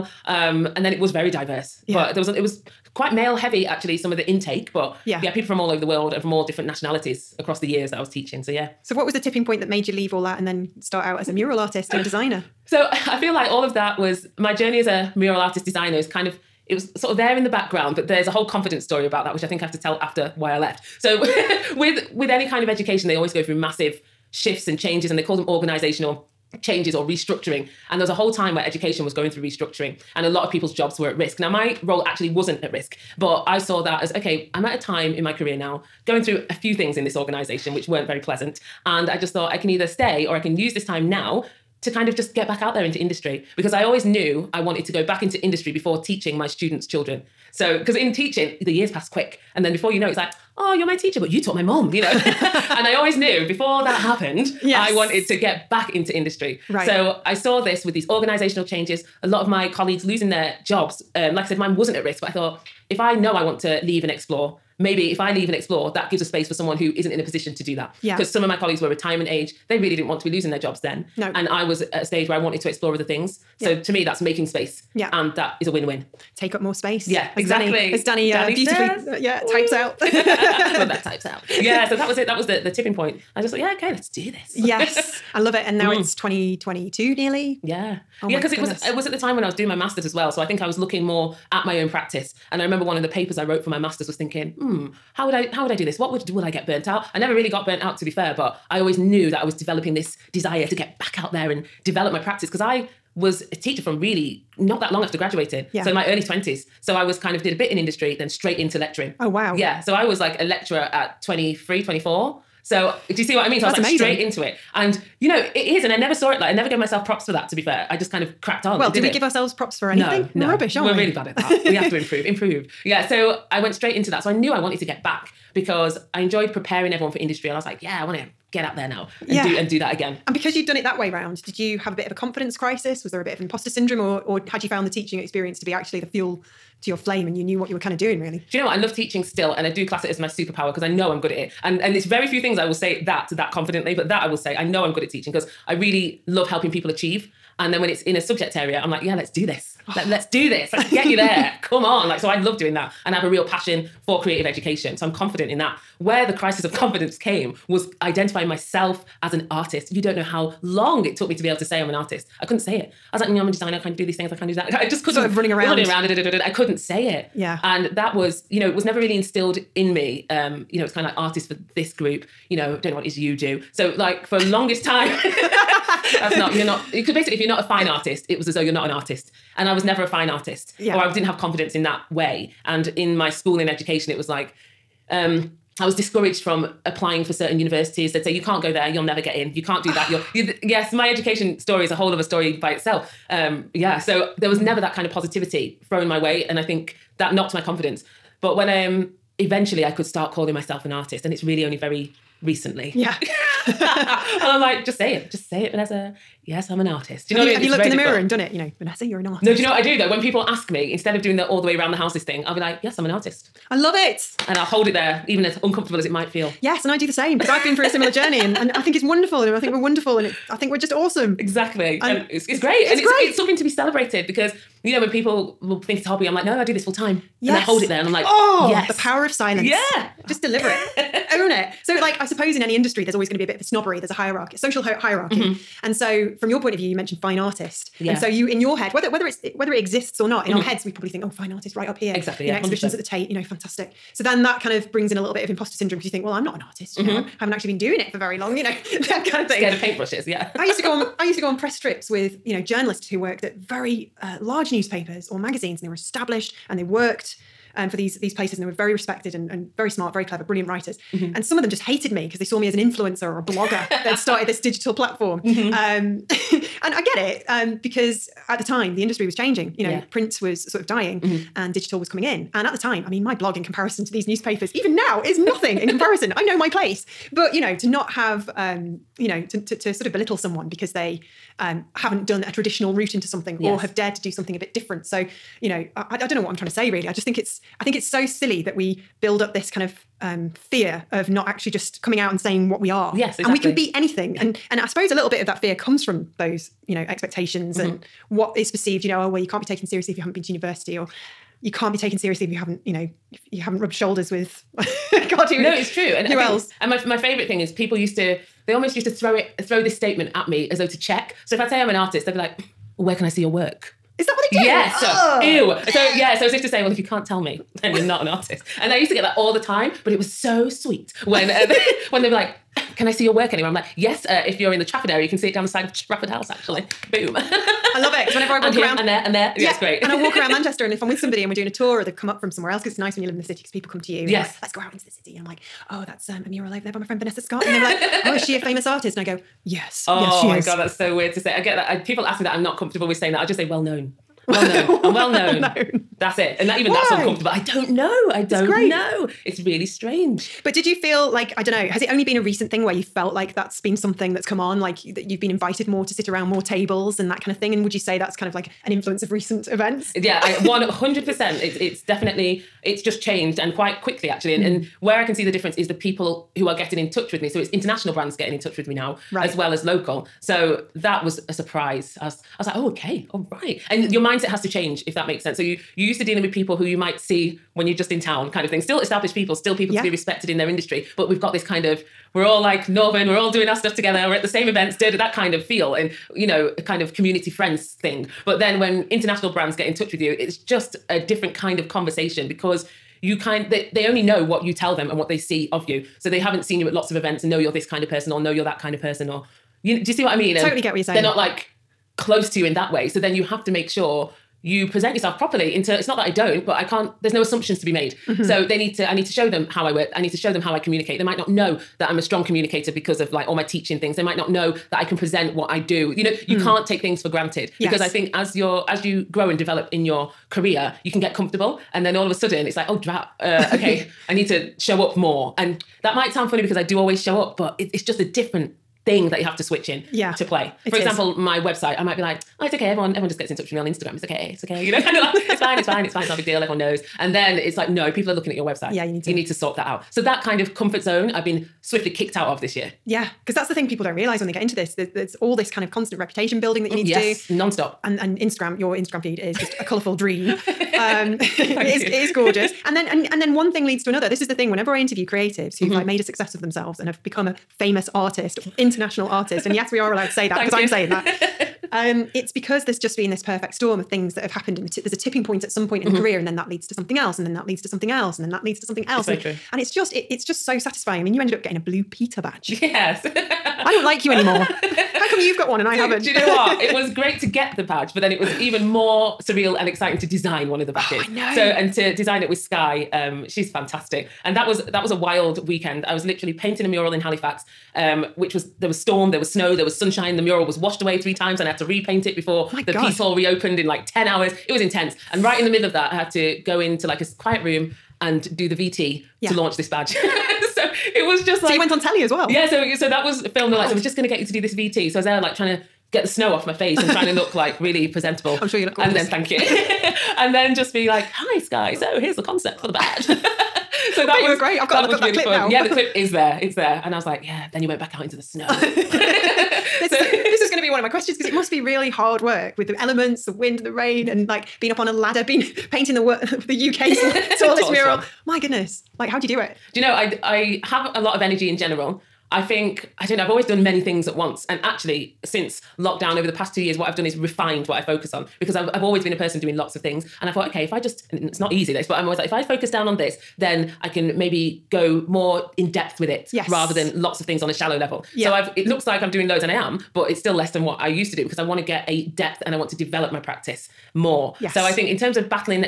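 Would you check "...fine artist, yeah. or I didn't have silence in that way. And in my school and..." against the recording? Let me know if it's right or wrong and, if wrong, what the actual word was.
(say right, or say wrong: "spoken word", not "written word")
wrong: "confidence", not "silence".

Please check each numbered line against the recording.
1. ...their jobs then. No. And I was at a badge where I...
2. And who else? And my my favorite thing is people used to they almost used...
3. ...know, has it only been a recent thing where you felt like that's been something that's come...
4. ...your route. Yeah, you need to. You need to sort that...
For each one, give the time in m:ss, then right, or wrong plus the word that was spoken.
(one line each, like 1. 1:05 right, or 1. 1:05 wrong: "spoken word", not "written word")
1. 1:10 wrong: "stage", not "badge"
2. 5:05 right
3. 5:51 right
4. 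7:18 wrong: "website", not "route".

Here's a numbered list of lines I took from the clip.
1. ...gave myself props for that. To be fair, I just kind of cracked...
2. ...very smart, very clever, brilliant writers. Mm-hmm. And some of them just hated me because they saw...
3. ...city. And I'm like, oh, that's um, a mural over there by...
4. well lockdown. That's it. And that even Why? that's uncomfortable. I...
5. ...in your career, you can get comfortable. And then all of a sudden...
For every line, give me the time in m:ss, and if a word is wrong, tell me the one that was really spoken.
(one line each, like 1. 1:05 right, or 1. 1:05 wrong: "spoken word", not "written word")
1. 1:56 right
2. 4:19 right
3. 5:35 right
4. 5:45 wrong: "known", not "lockdown"
5. 6:59 right.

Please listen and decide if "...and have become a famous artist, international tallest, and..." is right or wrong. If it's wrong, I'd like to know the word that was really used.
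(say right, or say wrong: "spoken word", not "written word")
wrong: "artist", not "tallest".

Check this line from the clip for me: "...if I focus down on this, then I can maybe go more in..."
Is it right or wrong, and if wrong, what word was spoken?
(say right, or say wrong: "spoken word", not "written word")
right.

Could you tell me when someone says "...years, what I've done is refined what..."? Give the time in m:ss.
8:56.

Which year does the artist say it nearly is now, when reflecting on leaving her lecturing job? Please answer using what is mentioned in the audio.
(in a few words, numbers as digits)
2022.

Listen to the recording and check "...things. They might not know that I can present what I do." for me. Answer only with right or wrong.
right.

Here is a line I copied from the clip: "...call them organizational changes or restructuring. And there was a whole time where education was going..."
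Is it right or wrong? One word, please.
right.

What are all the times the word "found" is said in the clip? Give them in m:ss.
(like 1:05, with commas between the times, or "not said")
2:14.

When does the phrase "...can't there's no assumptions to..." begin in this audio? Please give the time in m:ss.
6:46.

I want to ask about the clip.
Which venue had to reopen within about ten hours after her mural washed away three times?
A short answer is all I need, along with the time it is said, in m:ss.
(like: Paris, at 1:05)
the Piece Hall, at 8:12.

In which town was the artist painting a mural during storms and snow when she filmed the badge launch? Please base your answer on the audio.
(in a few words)
Halifax.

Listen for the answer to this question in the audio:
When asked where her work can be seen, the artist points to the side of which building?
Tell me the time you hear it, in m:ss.
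5:25.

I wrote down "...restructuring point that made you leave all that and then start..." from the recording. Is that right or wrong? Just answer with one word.
wrong.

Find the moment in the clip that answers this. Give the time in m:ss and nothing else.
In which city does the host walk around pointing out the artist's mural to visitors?
5:30.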